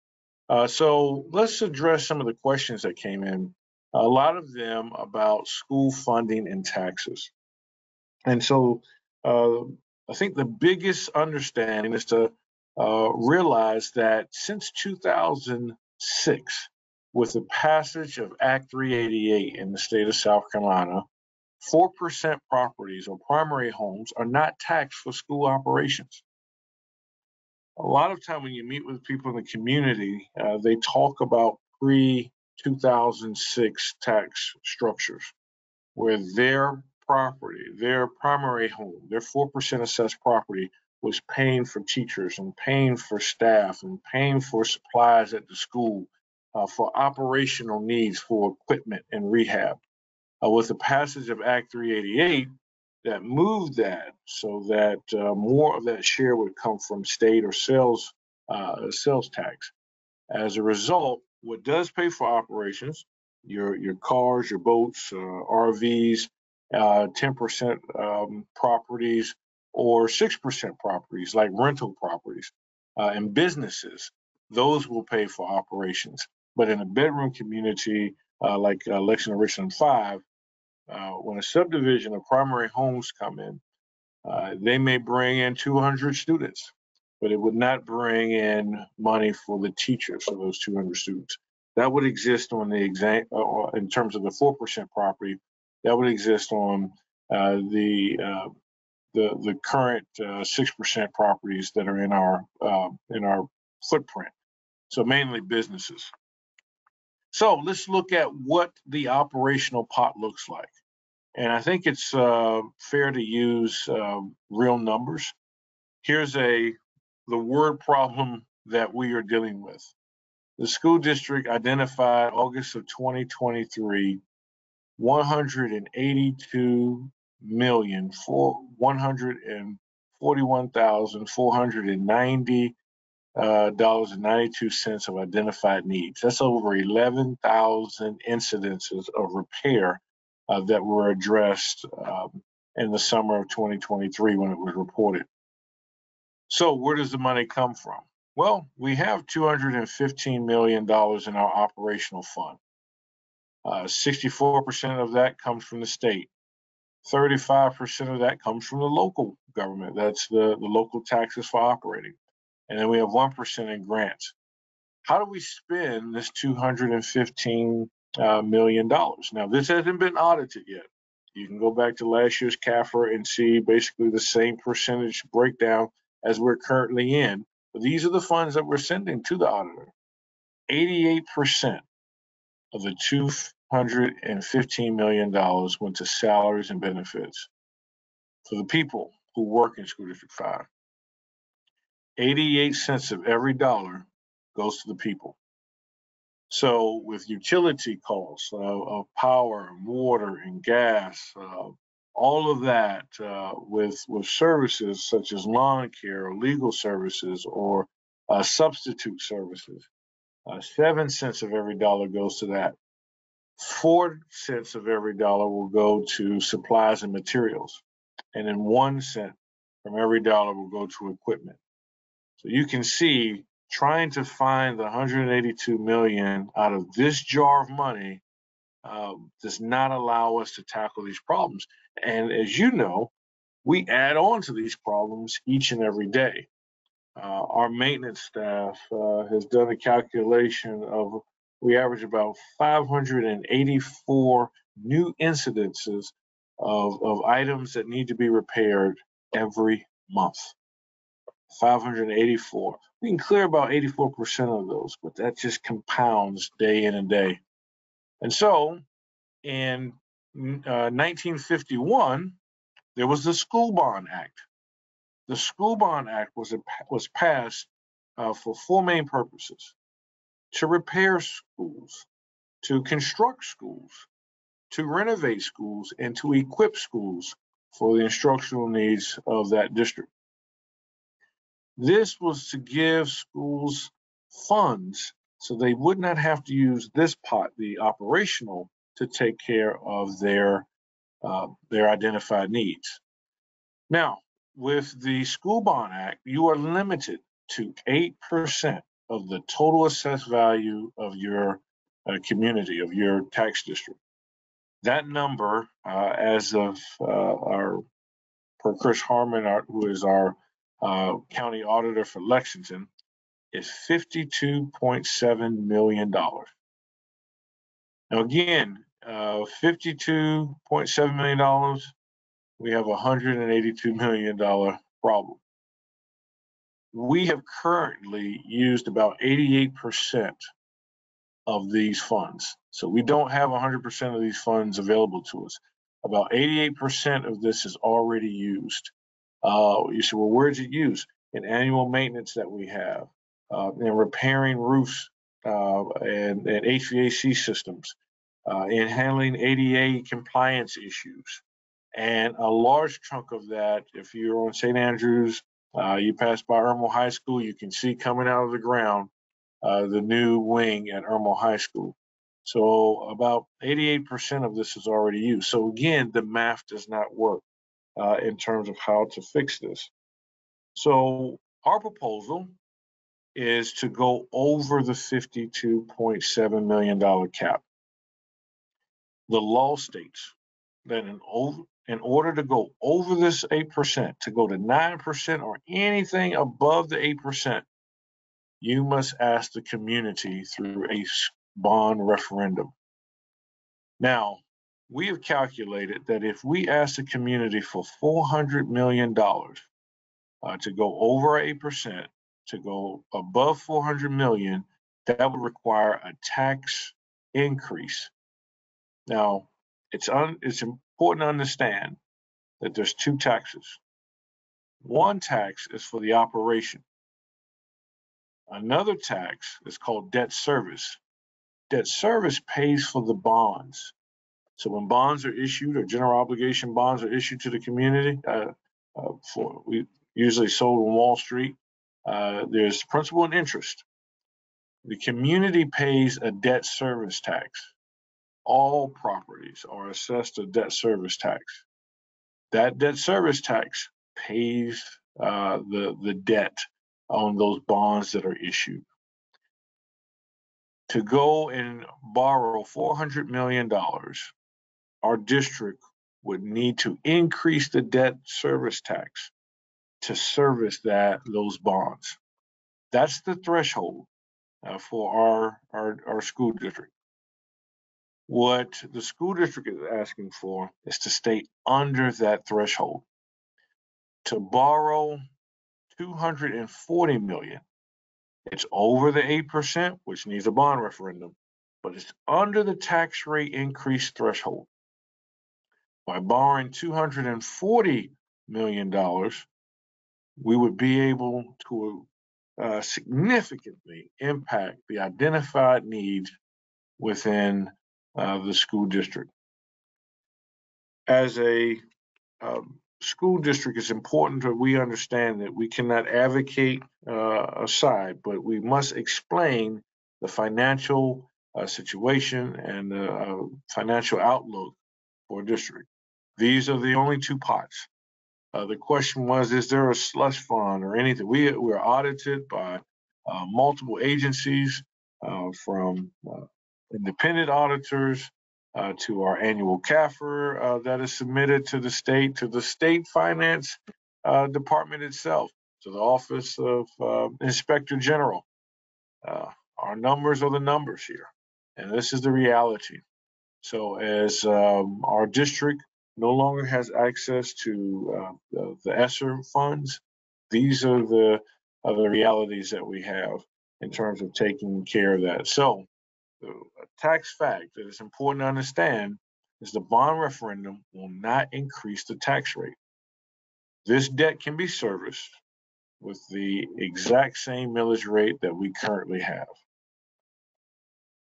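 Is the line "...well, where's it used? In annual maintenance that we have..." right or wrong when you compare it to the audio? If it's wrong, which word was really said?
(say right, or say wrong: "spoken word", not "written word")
right.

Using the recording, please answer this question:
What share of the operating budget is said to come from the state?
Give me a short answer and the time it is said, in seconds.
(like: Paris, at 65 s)
64%, at 153 s.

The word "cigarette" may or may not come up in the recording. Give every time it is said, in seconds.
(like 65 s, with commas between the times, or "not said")
not said.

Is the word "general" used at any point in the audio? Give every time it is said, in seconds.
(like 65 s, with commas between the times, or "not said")
425 s, 537 s.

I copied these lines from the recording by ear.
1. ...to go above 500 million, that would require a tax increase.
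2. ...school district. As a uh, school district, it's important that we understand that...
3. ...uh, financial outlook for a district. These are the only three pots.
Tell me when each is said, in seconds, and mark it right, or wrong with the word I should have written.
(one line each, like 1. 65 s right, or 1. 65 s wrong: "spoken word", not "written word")
1. 402 s wrong: "400", not "500"
2. 498 s right
3. 513 s wrong: "two", not "three".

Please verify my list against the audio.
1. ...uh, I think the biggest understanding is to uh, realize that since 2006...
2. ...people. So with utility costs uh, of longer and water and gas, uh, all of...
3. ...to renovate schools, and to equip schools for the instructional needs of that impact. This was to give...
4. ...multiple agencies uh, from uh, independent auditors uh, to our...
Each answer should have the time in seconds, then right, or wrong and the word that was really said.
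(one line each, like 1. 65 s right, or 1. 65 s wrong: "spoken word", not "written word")
1. 9 s right
2. 194 s wrong: "power", not "longer"
3. 274 s wrong: "district", not "impact"
4. 523 s right.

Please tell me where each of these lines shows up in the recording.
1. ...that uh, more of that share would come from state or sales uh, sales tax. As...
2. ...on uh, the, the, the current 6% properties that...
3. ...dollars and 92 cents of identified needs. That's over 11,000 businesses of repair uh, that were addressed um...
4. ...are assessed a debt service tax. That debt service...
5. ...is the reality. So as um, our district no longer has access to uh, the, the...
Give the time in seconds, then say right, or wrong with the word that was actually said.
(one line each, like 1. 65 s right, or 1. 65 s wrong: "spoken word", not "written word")
1. 54 s right
2. 96 s right
3. 133 s wrong: "incidences", not "businesses"
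4. 439 s right
5. 542 s right.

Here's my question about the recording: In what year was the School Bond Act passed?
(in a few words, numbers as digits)
1951.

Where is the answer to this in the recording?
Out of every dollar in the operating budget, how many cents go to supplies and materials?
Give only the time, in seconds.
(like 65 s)
213 s.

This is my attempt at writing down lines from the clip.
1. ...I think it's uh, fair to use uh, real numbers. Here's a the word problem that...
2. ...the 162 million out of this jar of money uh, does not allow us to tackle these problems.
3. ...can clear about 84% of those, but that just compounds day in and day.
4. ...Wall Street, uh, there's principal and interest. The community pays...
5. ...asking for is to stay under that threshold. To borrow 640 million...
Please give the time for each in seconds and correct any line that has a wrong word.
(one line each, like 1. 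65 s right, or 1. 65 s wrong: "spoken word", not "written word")
1. 111 s right
2. 224 s wrong: "182", not "162"
3. 253 s right
4. 430 s right
5. 469 s wrong: "240", not "640".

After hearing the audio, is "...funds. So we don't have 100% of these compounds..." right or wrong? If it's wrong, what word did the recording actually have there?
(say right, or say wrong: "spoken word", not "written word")
wrong: "funds", not "compounds".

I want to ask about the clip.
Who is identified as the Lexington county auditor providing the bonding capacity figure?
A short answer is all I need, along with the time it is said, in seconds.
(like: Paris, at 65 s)
Chris Harmon, at 308 s.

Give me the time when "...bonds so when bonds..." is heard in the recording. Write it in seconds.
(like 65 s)
423 s.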